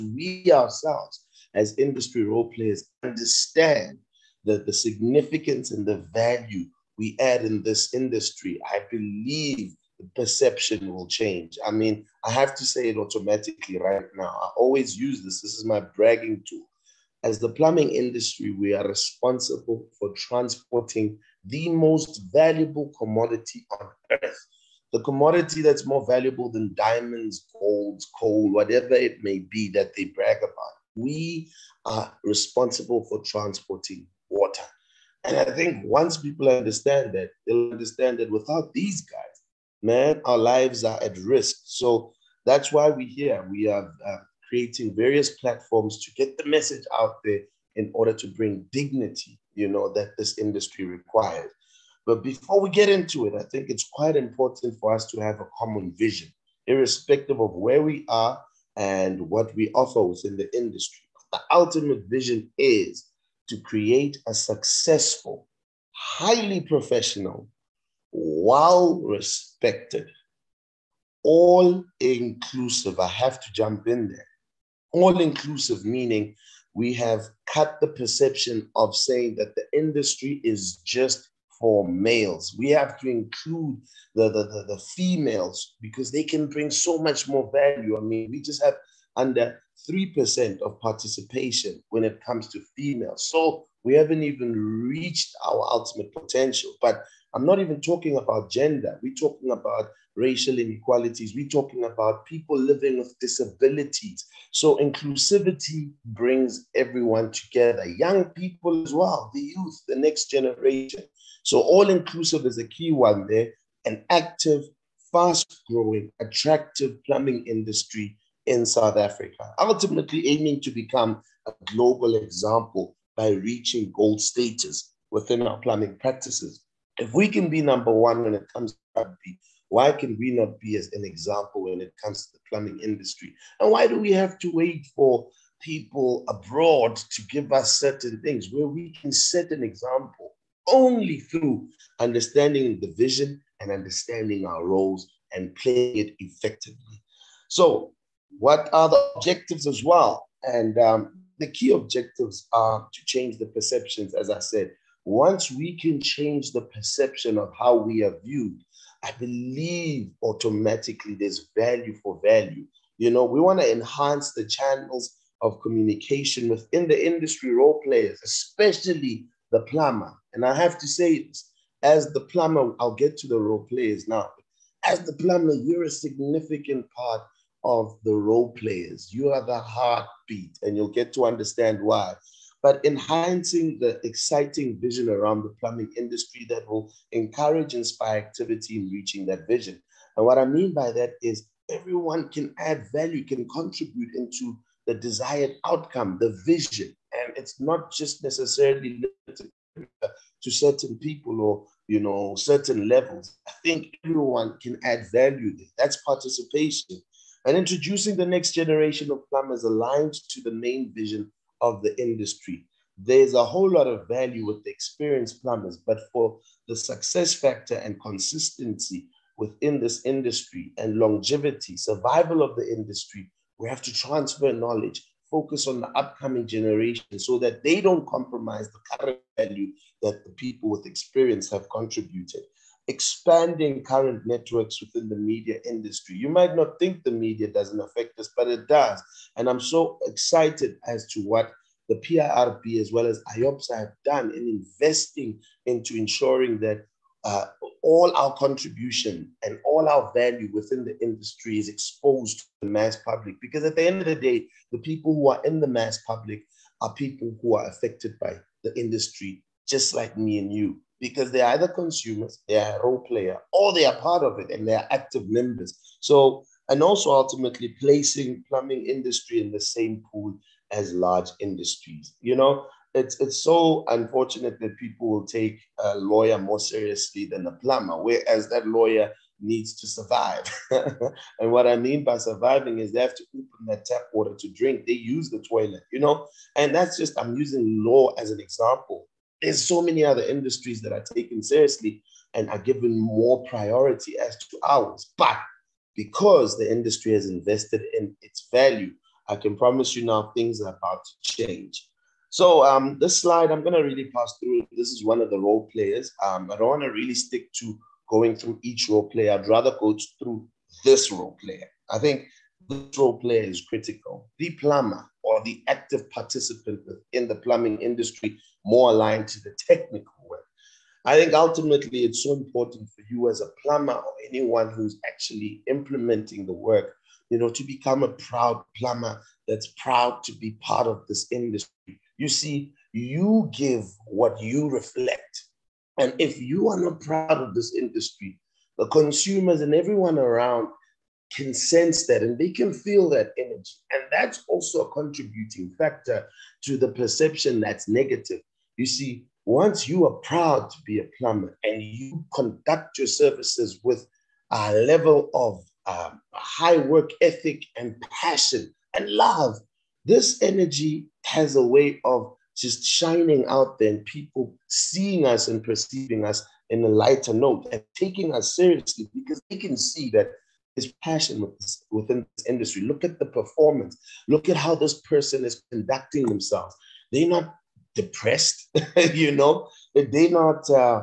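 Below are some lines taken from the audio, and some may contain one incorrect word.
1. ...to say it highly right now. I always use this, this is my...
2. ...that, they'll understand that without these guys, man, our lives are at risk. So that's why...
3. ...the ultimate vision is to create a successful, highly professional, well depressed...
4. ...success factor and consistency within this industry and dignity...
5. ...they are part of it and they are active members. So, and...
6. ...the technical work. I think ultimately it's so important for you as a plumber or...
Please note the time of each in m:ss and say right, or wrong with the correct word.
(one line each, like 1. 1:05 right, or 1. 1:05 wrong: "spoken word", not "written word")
1. 0:12 wrong: "automatically", not "highly"
2. 0:37 right
3. 1:01 wrong: "respected", not "depressed"
4. 3:36 wrong: "longevity", not "dignity"
5. 4:23 right
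6. 5:19 right.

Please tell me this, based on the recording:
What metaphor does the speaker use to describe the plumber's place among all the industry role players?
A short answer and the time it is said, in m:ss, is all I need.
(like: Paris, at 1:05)
The heartbeat, at 2:59.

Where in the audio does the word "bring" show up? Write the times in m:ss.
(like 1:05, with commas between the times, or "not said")
0:48, 1:26, 1:46.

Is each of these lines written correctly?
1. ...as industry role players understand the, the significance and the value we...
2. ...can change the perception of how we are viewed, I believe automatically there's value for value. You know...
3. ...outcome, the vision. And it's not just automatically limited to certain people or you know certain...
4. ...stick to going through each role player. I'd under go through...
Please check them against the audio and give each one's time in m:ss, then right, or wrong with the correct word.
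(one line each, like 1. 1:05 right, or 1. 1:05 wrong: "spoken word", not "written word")
1. 0:01 right
2. 2:35 right
3. 3:15 wrong: "necessarily", not "automatically"
4. 5:07 wrong: "rather", not "under".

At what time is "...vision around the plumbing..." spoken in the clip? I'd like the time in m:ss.
3:04.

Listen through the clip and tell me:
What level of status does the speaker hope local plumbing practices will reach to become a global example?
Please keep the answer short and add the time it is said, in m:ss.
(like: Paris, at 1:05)
Gold status, at 2:03.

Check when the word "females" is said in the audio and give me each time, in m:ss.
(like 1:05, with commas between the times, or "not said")
1:24, 1:32.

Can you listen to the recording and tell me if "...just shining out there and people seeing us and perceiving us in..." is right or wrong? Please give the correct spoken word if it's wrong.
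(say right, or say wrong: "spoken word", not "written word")
right.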